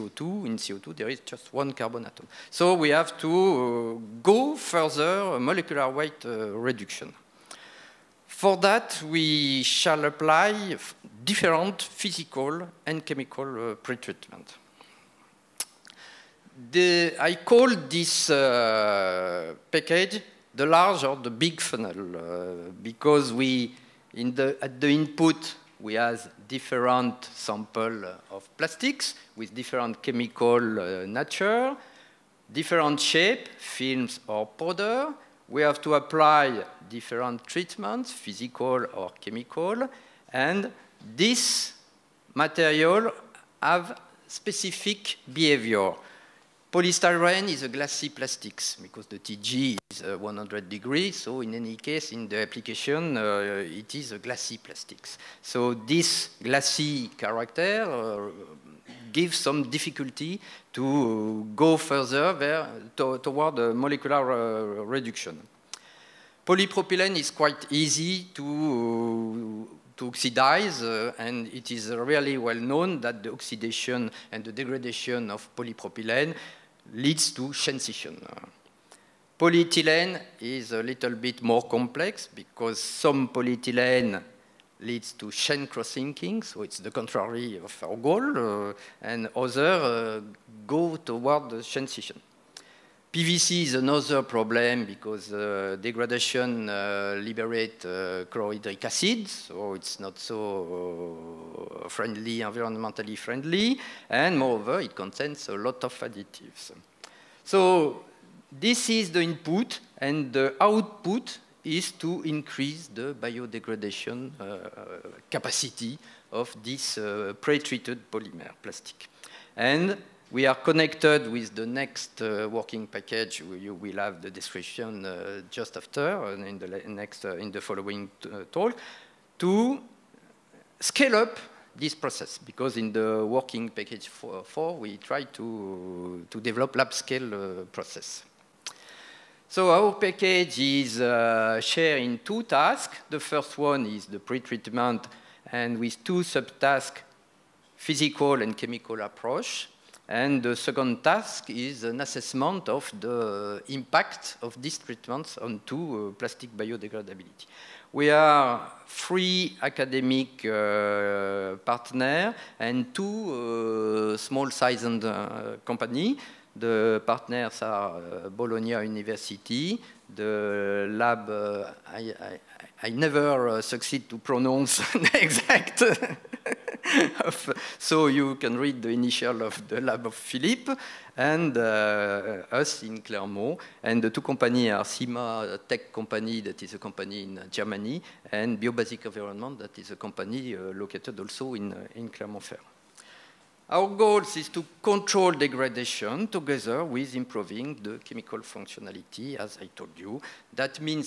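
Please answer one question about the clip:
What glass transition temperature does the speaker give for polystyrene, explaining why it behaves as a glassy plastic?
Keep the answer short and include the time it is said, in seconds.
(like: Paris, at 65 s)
100 degrees, at 50 s.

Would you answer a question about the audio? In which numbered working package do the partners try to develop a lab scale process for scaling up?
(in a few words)
4.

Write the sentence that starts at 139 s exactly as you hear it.
So our package is uh, shared in two tasks.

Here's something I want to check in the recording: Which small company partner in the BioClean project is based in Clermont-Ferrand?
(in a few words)
Biobasic Environment.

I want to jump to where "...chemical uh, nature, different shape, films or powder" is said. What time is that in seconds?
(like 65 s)
30 s.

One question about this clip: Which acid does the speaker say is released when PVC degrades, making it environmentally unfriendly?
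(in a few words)
Chlorhydric acid.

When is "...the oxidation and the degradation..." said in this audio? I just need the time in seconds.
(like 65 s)
73 s.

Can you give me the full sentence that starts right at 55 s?
So this glassy character uh, gives some difficulty to go further there, to, toward the molecular uh, reduction.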